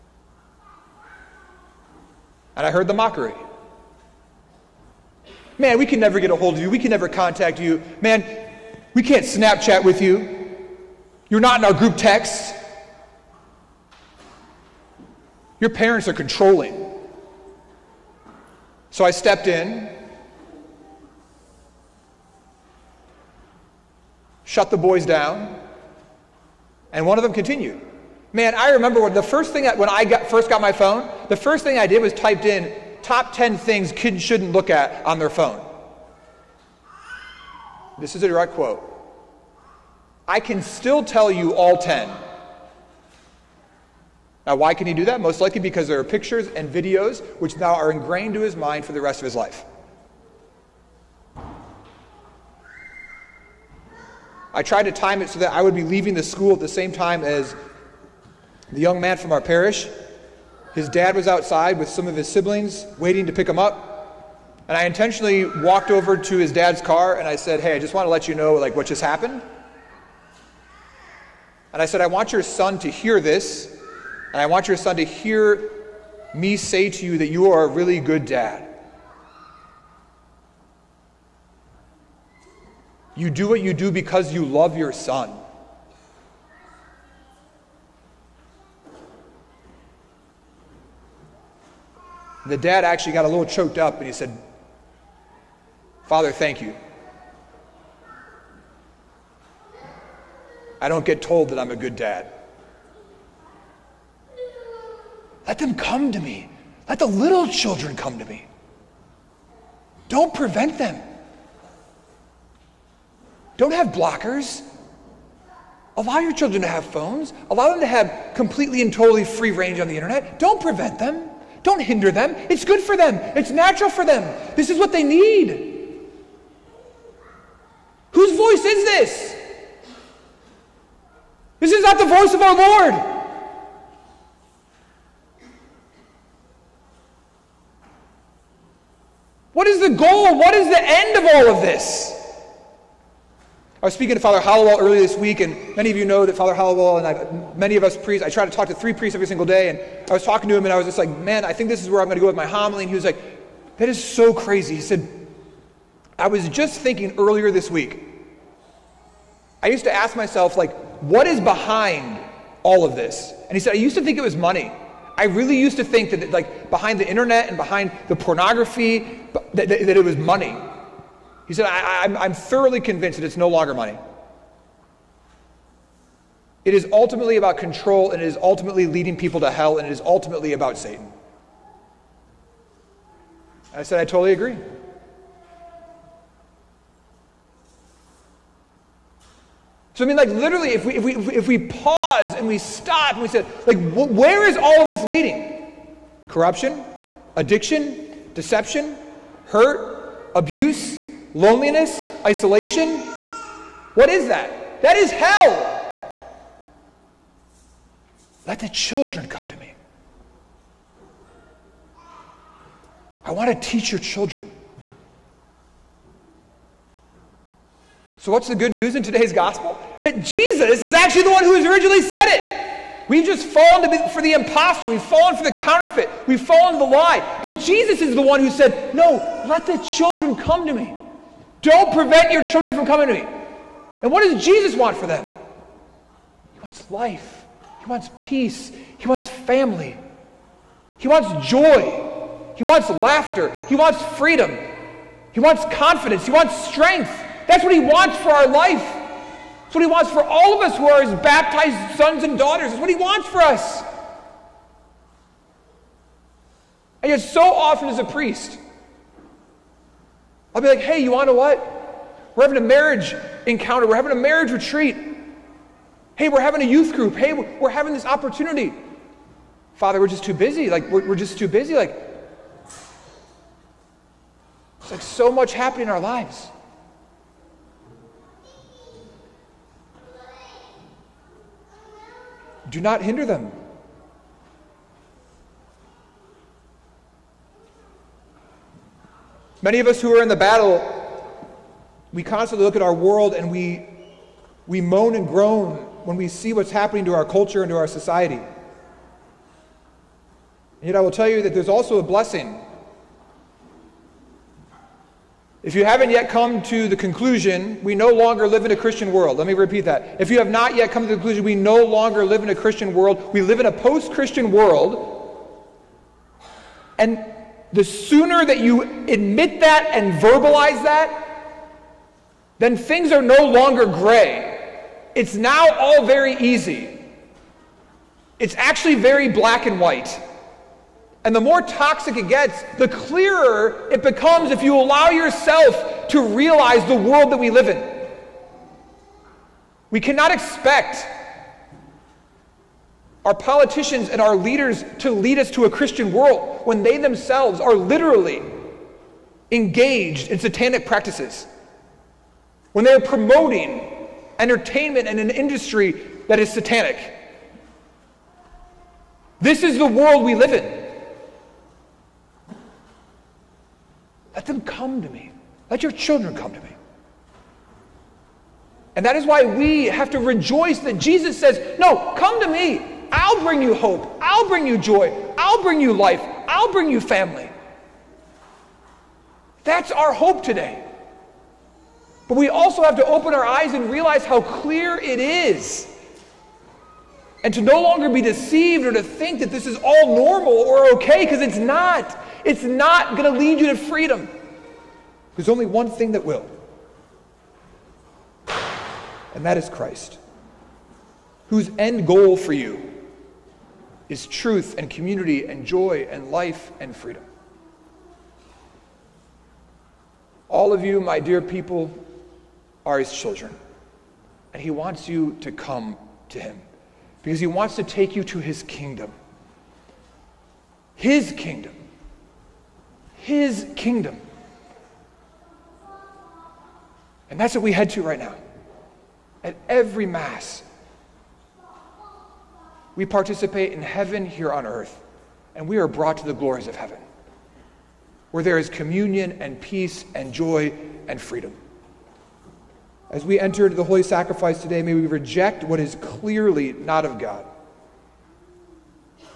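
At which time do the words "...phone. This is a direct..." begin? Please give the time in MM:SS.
00:35.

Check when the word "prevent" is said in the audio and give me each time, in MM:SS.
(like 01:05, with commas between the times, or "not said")
01:50, 02:00, 03:51.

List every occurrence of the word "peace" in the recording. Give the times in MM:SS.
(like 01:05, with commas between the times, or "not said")
03:58, 07:19.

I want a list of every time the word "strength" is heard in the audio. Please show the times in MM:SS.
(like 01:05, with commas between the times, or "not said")
04:06.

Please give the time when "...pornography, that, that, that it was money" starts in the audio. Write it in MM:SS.
02:48.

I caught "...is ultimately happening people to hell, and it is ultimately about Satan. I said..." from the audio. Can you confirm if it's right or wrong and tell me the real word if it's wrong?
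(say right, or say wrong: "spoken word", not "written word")
wrong: "leading", not "happening".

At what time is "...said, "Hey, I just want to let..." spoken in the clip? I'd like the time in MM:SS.
01:07.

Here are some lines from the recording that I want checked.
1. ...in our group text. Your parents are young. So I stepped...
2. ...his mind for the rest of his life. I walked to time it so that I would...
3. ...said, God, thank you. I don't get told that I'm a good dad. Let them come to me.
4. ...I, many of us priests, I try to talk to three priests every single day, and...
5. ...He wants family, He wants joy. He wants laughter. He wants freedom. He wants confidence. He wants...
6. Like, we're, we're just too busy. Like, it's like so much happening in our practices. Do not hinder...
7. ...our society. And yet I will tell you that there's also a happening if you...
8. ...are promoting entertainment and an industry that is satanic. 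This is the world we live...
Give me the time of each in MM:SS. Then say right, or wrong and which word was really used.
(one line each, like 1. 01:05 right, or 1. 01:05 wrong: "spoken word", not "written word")
1. 00:11 wrong: "controlling", not "young"
2. 00:48 wrong: "tried", not "walked"
3. 01:34 wrong: "Father", not "God"
4. 02:27 right
5. 03:58 right
6. 04:30 wrong: "lives", not "practices"
7. 04:57 wrong: "blessing", not "happening"
8. 05:52 right.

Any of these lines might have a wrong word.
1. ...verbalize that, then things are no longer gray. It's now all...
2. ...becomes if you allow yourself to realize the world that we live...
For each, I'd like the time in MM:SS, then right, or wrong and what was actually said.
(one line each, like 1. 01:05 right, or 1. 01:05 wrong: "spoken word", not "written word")
1. 05:20 right
2. 05:34 right.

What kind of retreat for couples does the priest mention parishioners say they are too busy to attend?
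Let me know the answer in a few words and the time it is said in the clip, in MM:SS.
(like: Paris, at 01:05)
Marriage retreat, at 04:24.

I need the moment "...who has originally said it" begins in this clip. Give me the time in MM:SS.
03:41.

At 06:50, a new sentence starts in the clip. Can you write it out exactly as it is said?
All of you, my dear people, are his children.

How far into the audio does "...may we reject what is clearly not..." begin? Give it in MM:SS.
07:24.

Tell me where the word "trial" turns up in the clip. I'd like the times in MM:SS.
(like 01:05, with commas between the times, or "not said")
not said.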